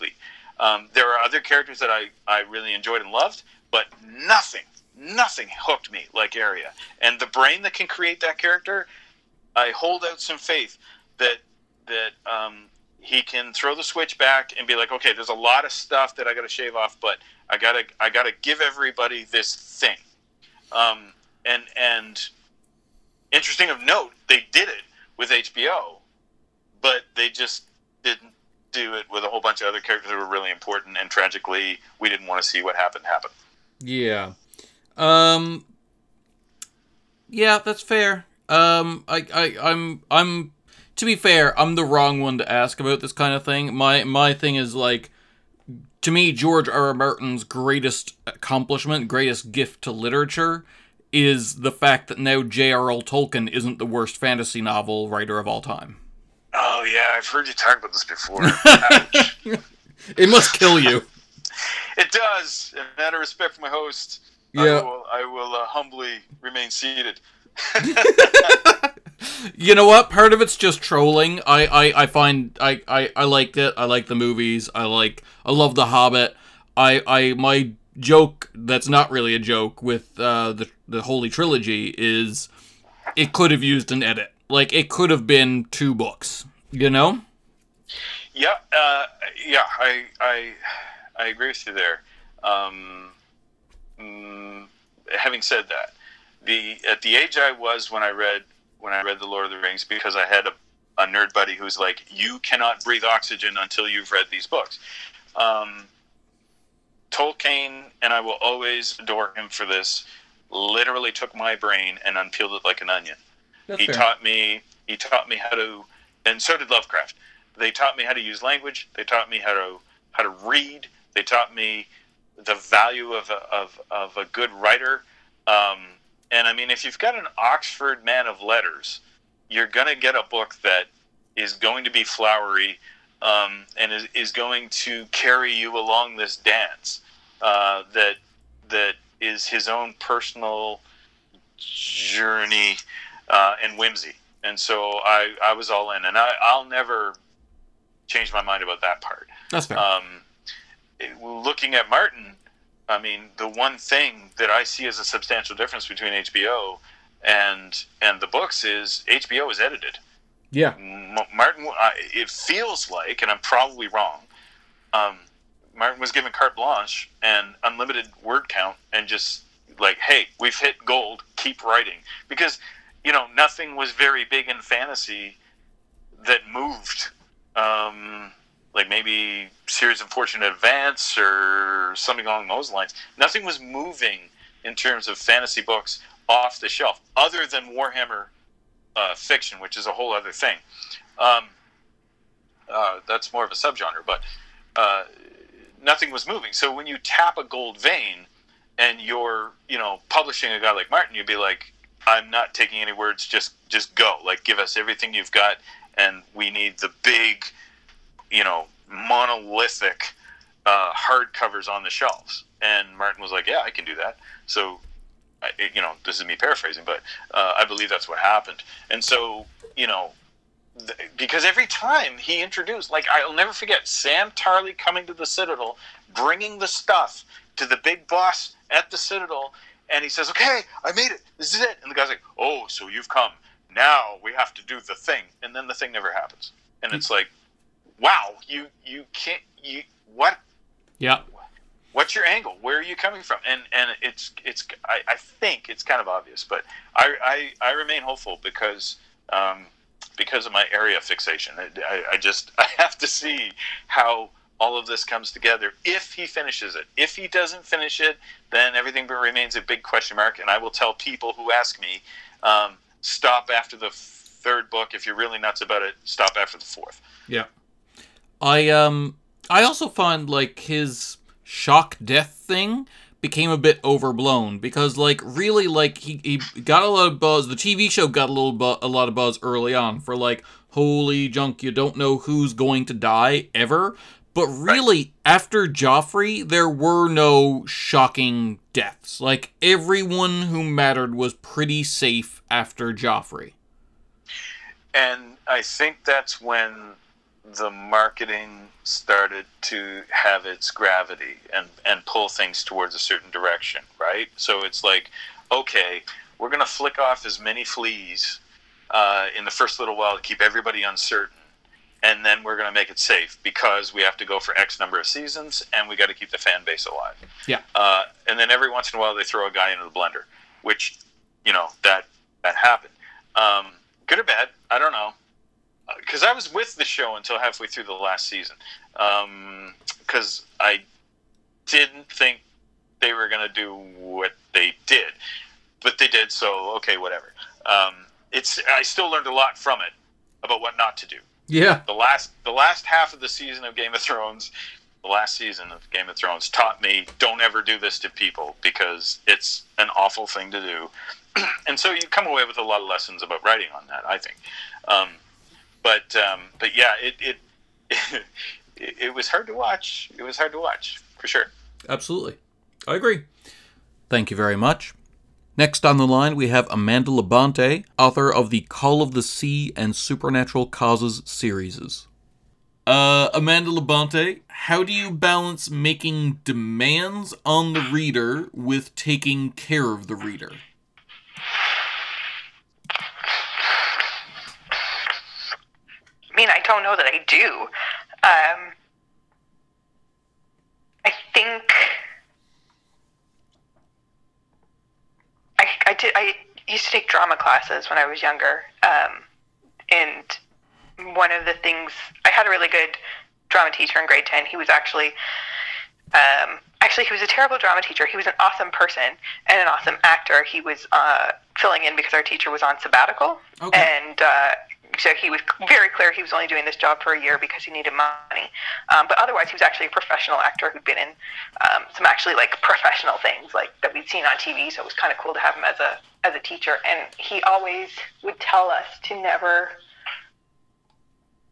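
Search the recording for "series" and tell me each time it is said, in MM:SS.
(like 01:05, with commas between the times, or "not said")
02:59, 06:11.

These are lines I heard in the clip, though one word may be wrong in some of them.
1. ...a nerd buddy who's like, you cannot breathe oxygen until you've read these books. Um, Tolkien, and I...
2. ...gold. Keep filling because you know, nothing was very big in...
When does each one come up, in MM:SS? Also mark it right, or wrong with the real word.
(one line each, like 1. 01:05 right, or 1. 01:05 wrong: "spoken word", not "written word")
1. 01:40 right
2. 02:50 wrong: "writing", not "filling".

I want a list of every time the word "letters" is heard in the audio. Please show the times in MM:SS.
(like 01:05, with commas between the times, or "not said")
02:08.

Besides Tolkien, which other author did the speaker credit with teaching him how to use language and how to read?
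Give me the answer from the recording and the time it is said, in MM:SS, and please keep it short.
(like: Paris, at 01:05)
Lovecraft, at 01:56.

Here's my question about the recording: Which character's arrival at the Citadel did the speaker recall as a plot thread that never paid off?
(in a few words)
Sam Tarly.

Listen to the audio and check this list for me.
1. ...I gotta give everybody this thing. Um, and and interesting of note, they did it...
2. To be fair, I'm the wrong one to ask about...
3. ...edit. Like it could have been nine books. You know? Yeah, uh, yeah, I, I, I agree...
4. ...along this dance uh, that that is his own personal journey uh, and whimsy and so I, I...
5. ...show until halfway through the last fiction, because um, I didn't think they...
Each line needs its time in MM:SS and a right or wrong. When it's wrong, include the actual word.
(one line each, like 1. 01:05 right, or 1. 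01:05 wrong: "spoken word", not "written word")
1. 00:18 right
2. 00:40 right
3. 01:24 wrong: "two", not "nine"
4. 02:15 right
5. 05:26 wrong: "season", not "fiction".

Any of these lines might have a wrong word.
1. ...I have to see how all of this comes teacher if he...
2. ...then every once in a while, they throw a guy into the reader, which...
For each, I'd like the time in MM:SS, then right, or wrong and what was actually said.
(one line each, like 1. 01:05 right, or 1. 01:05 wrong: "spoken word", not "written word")
1. 04:12 wrong: "together", not "teacher"
2. 05:18 wrong: "blender", not "reader".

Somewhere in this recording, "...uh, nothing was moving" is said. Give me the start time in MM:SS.
03:14.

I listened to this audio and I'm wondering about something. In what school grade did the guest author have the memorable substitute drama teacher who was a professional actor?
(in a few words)
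Grade 10.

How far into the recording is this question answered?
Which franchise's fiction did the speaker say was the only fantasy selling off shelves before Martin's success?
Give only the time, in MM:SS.
03:07.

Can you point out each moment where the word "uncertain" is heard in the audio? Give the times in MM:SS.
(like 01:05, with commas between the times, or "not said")
05:10.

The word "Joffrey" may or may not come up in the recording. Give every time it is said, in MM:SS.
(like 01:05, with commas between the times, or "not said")
04:45, 04:52.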